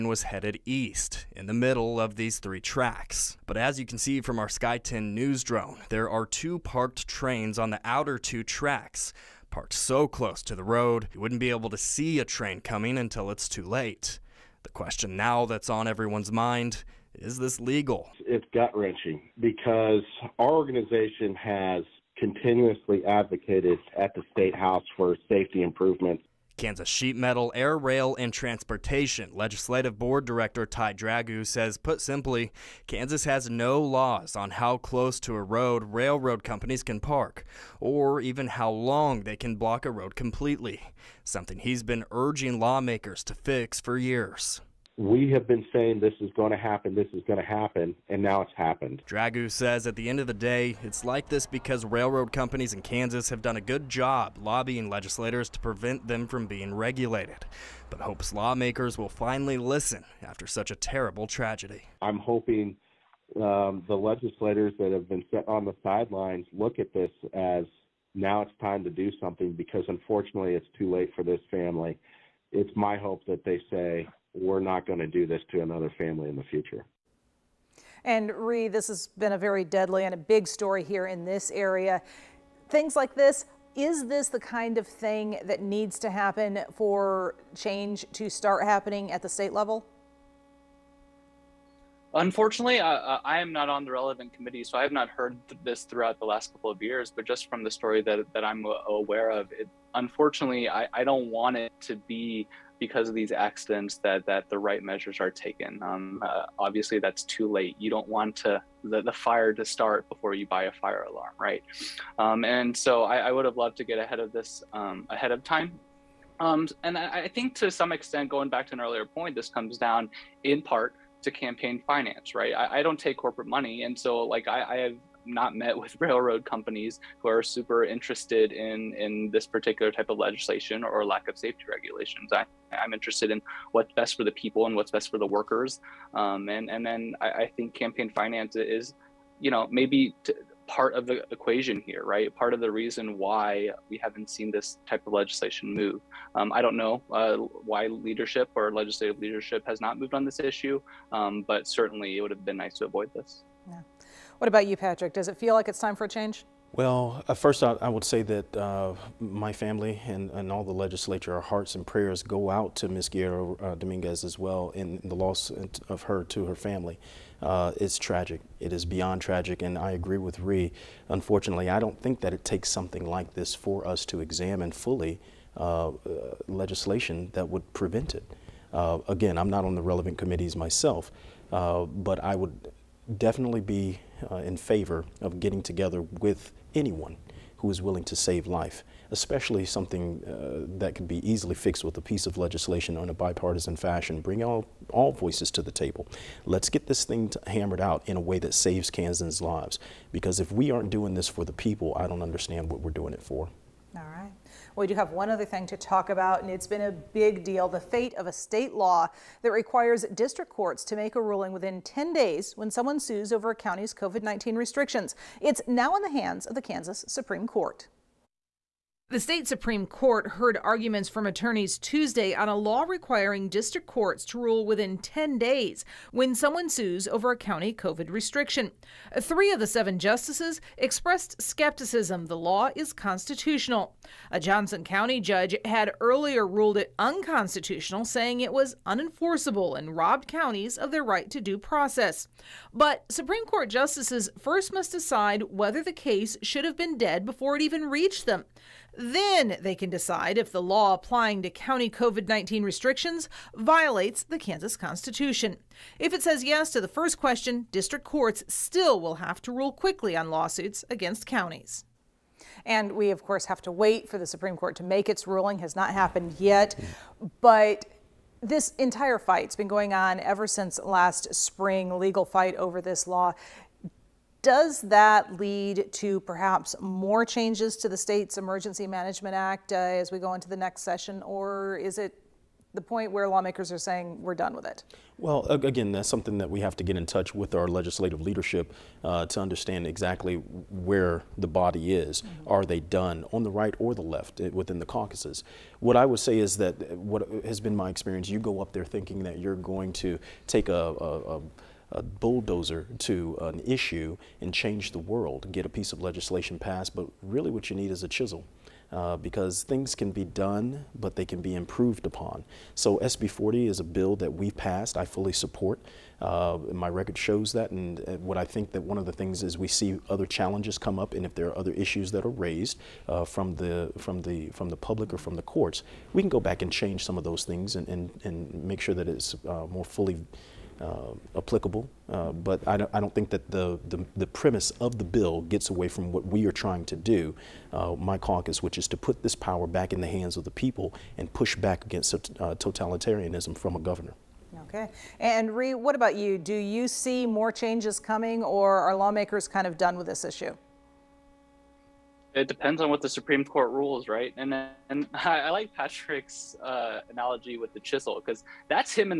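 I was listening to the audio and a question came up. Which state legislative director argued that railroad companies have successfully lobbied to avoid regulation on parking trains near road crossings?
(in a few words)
Ty Dragoo.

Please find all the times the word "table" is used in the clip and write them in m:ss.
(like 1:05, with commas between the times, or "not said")
3:15.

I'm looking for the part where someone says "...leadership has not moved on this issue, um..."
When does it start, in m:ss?
2:29.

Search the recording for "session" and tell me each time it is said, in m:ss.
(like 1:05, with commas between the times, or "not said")
4:40.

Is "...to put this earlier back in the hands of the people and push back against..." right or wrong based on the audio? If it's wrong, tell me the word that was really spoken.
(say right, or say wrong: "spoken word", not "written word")
wrong: "power", not "earlier".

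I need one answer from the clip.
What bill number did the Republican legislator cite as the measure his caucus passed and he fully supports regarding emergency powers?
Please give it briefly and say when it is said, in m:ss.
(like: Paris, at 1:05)
SB 40, at 5:12.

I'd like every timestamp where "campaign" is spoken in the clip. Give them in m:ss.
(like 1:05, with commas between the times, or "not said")
2:01, 2:17.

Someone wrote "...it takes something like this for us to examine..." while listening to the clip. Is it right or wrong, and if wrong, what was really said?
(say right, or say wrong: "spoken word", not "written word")
right.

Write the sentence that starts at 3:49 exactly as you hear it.
Three of the seven justices expressed skepticism the law is constitutional.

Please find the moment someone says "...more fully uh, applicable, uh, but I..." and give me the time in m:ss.
5:29.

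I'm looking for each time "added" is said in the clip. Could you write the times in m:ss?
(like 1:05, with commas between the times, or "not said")
not said.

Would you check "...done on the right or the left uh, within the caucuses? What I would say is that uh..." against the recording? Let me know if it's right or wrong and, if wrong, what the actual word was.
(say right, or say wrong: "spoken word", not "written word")
right.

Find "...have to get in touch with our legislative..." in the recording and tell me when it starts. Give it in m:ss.
4:46.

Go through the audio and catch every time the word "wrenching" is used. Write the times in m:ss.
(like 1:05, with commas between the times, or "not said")
0:18.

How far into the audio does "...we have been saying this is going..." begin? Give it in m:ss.
0:44.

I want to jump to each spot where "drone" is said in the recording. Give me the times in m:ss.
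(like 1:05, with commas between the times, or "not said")
0:05.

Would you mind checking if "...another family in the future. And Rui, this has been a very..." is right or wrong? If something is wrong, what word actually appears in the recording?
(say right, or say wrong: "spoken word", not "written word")
right.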